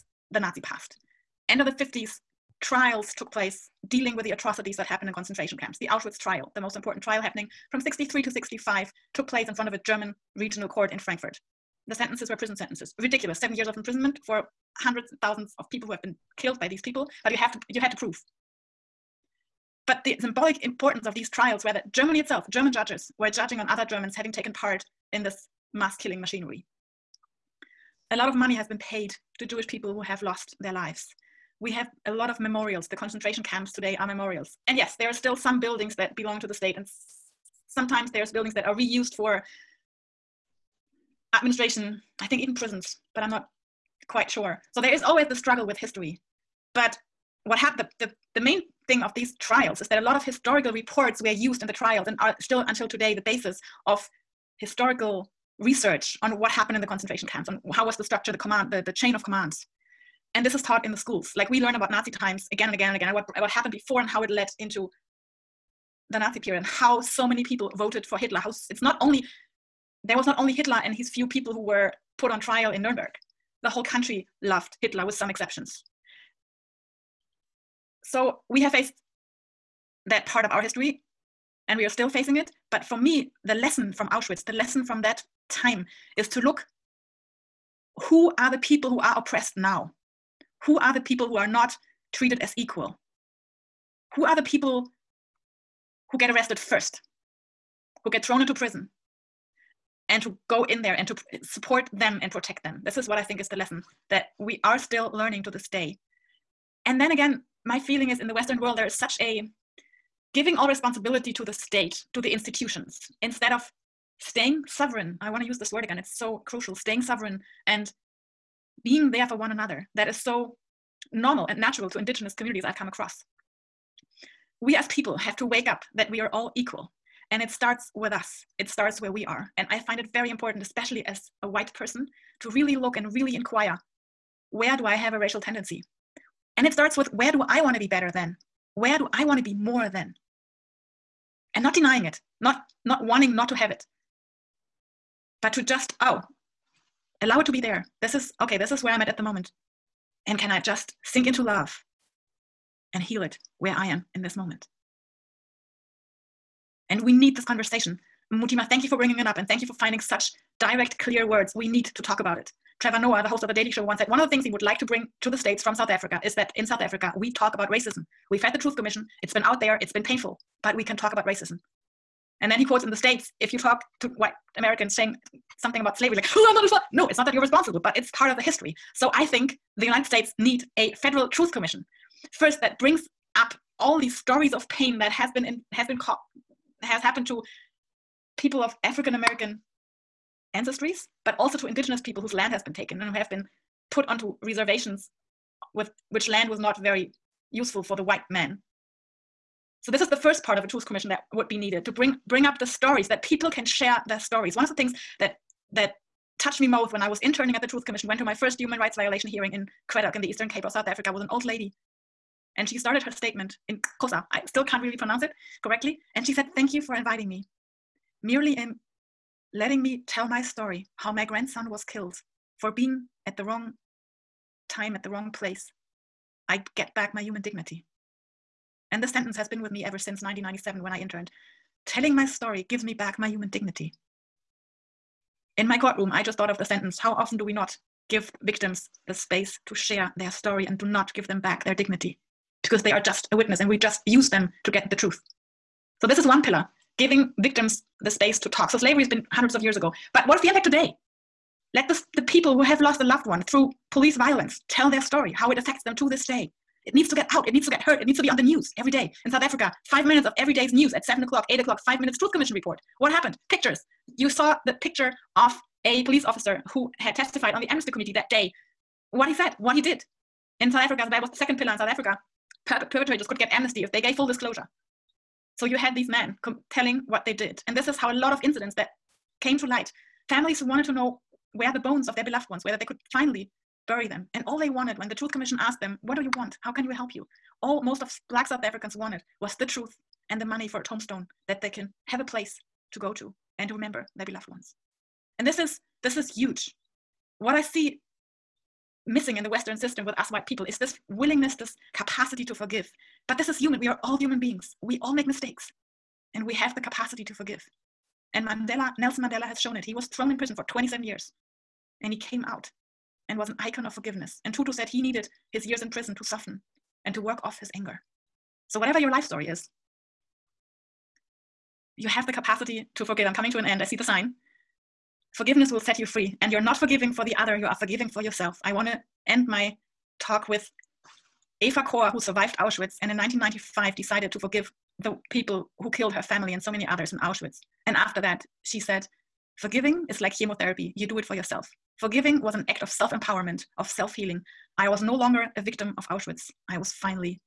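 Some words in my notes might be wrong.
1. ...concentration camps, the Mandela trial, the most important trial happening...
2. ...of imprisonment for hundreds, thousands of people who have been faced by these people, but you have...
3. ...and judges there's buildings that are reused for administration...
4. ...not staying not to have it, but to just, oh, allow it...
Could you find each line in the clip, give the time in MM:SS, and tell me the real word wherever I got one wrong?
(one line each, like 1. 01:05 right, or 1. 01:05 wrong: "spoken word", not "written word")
1. 00:05 wrong: "Auschwitz", not "Mandela"
2. 00:13 wrong: "killed", not "faced"
3. 00:36 wrong: "sometimes", not "judges"
4. 02:22 wrong: "wanting", not "staying".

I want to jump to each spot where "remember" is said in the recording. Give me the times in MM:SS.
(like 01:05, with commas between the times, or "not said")
04:53.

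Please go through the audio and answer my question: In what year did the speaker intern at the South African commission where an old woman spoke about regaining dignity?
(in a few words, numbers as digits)
1997.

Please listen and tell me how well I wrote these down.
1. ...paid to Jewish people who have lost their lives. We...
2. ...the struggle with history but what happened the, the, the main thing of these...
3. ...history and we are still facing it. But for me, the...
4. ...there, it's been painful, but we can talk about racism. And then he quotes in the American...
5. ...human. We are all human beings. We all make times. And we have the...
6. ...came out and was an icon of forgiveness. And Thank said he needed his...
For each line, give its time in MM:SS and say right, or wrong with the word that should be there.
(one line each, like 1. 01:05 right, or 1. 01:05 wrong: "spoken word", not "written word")
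1. 00:28 right
2. 00:45 right
3. 01:20 right
4. 02:49 wrong: "States", not "American"
5. 05:03 wrong: "mistakes", not "times"
6. 05:12 wrong: "Tutu", not "Thank".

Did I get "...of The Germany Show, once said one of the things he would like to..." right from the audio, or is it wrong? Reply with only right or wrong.
wrong.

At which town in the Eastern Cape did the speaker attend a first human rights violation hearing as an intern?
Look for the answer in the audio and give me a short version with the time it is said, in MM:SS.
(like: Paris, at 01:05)
Cradock, at 03:29.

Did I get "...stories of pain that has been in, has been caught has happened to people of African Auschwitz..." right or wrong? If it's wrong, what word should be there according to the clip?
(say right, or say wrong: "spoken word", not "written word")
wrong: "American", not "Auschwitz".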